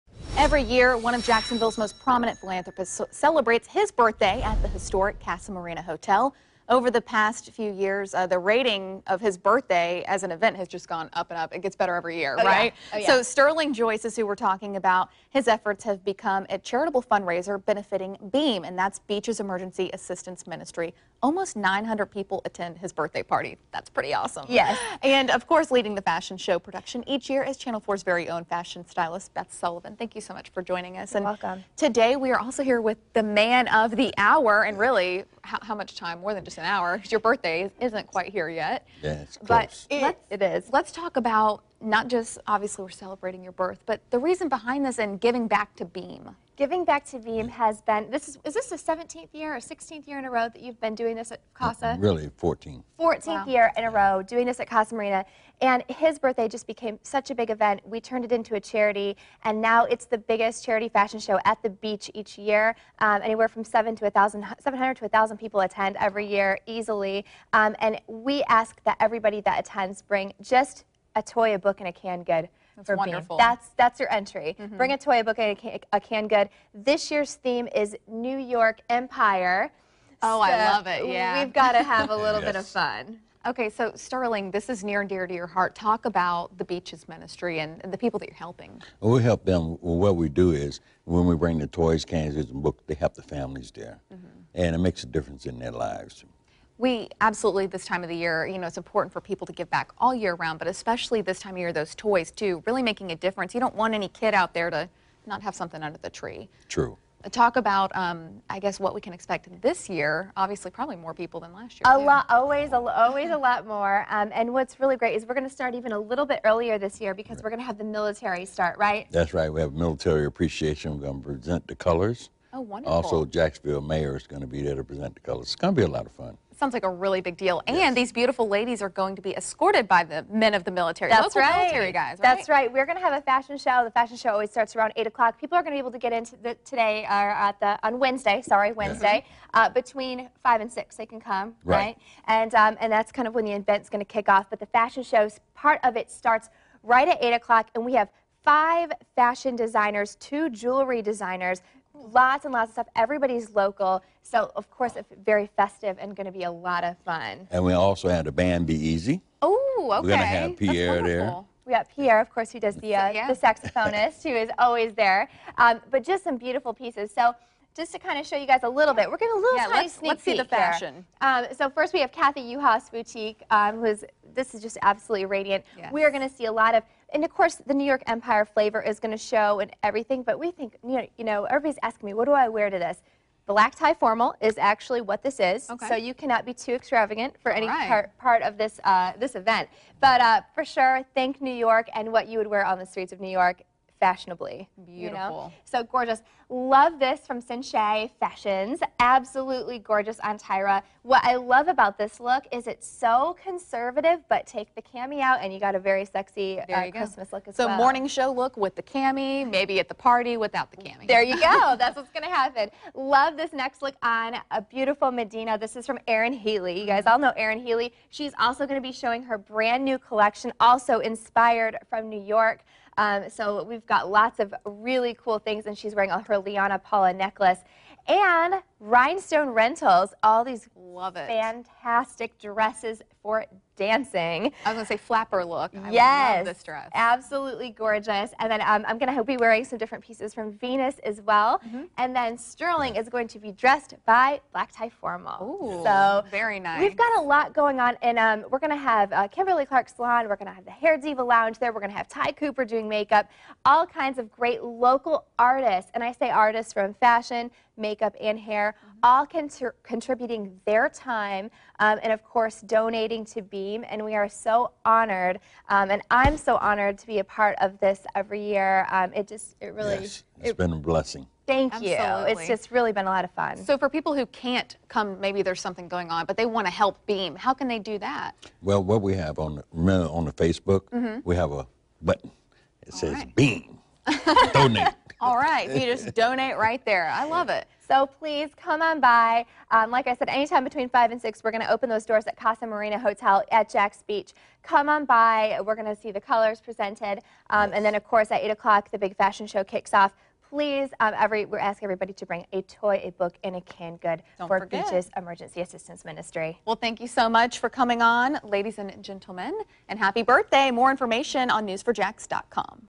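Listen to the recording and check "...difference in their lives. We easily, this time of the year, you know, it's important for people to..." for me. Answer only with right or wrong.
wrong.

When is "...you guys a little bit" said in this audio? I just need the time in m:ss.
2:48.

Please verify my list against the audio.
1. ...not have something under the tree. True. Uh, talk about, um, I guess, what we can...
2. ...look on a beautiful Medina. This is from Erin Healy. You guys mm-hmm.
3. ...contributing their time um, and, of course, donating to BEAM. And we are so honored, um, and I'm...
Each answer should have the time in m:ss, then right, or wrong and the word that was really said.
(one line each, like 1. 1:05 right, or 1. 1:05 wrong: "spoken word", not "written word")
1. 1:45 right
2. 3:33 right
3. 4:19 right.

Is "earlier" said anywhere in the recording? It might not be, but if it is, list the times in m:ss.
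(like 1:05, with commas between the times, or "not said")
1:56.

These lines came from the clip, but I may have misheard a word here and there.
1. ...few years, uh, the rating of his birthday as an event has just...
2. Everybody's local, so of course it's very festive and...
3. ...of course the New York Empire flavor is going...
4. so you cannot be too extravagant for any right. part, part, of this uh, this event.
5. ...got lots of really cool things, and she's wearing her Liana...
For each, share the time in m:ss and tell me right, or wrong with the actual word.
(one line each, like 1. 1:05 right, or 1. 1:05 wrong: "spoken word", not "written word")
1. 0:07 right
2. 2:32 right
3. 2:57 right
4. 3:05 right
5. 3:43 right.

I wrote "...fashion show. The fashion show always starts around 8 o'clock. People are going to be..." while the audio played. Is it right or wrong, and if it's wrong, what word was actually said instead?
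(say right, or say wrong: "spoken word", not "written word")
right.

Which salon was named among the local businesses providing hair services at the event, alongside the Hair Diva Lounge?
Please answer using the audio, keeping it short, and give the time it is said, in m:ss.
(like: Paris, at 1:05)
Kimberly Clark Salon, at 4:09.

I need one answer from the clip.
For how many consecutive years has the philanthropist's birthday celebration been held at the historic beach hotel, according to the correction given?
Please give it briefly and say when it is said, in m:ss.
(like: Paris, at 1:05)
14, at 0:51.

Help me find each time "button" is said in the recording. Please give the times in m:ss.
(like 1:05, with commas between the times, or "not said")
4:42.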